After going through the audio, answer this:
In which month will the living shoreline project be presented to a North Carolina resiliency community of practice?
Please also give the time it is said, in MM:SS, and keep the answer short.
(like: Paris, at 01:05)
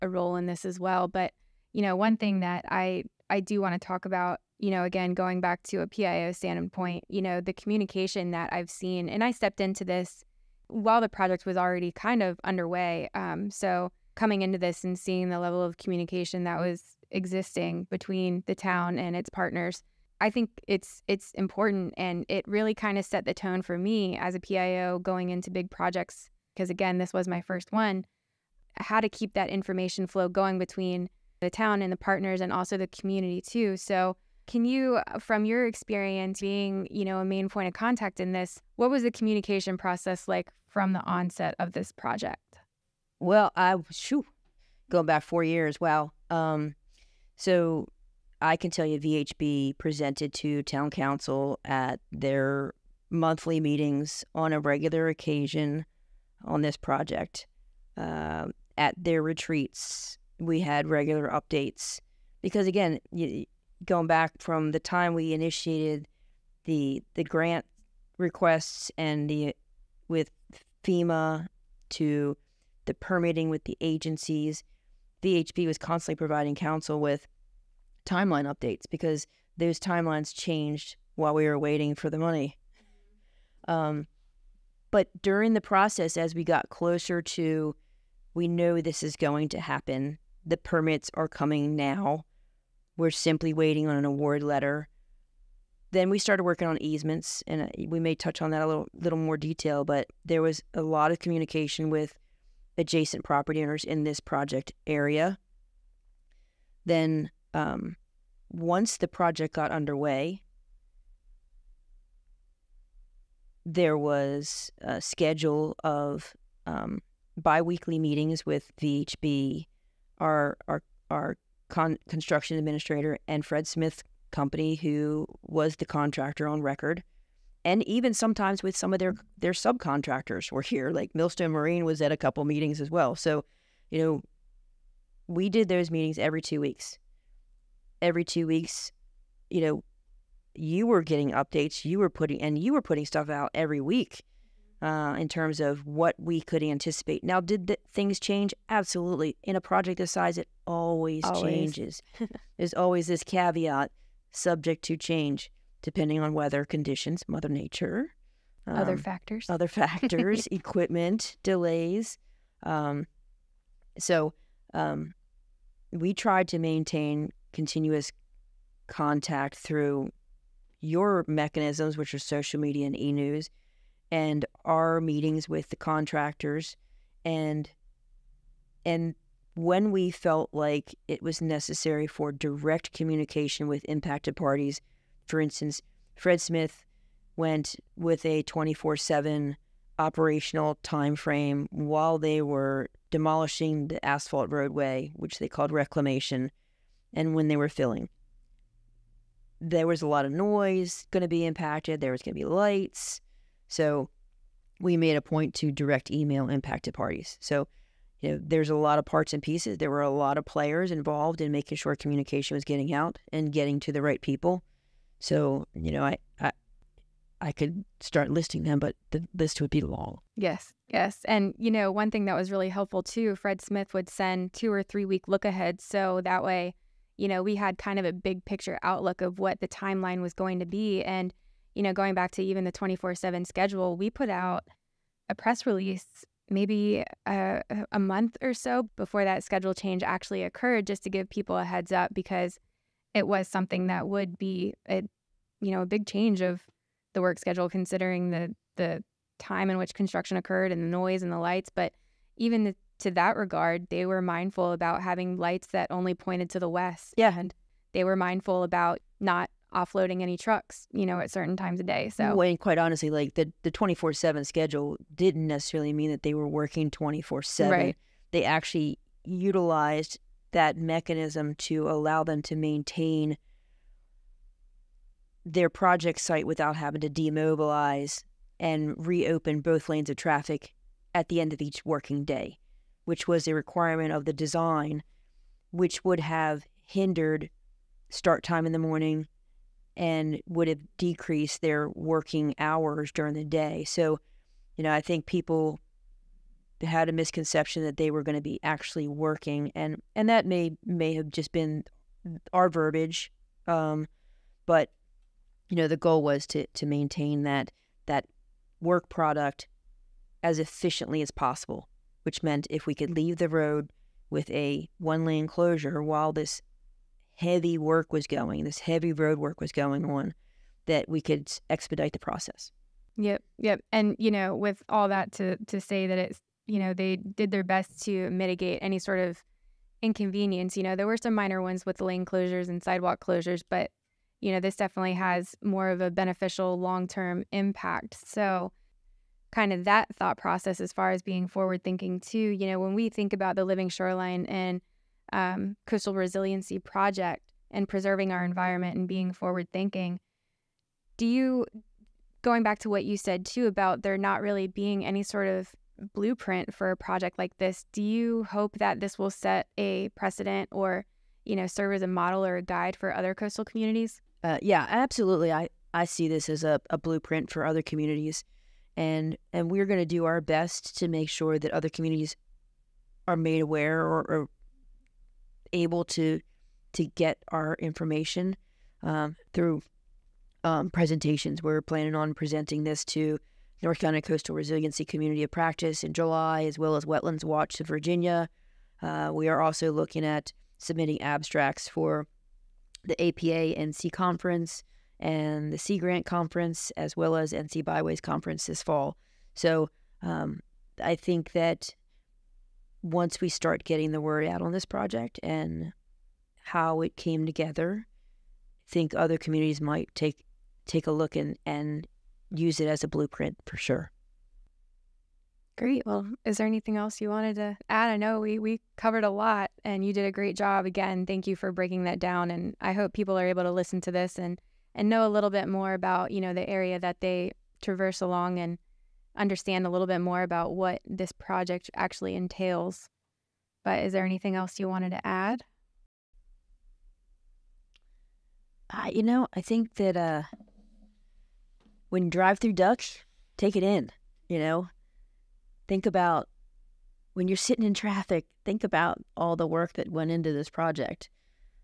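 July, at 06:26.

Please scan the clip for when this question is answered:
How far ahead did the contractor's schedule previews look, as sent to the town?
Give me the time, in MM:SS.
03:44.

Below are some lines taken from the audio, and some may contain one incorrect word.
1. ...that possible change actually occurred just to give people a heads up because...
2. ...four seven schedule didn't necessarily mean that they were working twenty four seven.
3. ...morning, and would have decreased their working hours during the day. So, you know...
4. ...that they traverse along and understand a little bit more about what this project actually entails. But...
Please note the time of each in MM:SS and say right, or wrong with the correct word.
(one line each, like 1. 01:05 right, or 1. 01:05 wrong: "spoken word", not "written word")
1. 03:59 wrong: "schedule", not "possible"
2. 04:23 right
3. 04:48 right
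4. 07:06 right.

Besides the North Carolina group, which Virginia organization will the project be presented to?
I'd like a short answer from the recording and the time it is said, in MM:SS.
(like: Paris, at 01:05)
Wetlands Watch, at 06:27.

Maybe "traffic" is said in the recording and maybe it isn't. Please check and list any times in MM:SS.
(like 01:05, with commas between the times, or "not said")
04:40, 07:27.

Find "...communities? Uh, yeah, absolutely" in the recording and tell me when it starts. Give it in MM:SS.
06:03.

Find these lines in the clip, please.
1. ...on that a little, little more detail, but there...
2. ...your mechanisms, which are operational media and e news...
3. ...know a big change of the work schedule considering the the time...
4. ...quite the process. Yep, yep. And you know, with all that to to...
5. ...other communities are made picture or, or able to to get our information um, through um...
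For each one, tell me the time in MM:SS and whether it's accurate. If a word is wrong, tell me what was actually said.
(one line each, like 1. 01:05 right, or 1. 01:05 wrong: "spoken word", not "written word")
1. 01:38 right
2. 02:50 wrong: "social", not "operational"
3. 04:05 right
4. 05:21 wrong: "expedite", not "quite"
5. 06:11 wrong: "aware", not "picture".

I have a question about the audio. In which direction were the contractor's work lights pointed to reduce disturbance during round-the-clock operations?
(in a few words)
West.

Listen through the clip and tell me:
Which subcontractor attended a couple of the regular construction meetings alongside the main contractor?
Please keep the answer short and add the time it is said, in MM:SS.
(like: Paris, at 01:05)
Millstone Marine, at 02:11.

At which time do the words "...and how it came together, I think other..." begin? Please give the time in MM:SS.
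06:45.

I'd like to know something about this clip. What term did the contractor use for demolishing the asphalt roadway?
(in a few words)
Reclamation.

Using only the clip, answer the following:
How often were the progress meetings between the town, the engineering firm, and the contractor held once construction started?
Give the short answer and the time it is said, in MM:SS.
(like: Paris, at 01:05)
Every two weeks, at 01:57.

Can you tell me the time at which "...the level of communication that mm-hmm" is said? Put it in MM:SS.
00:15.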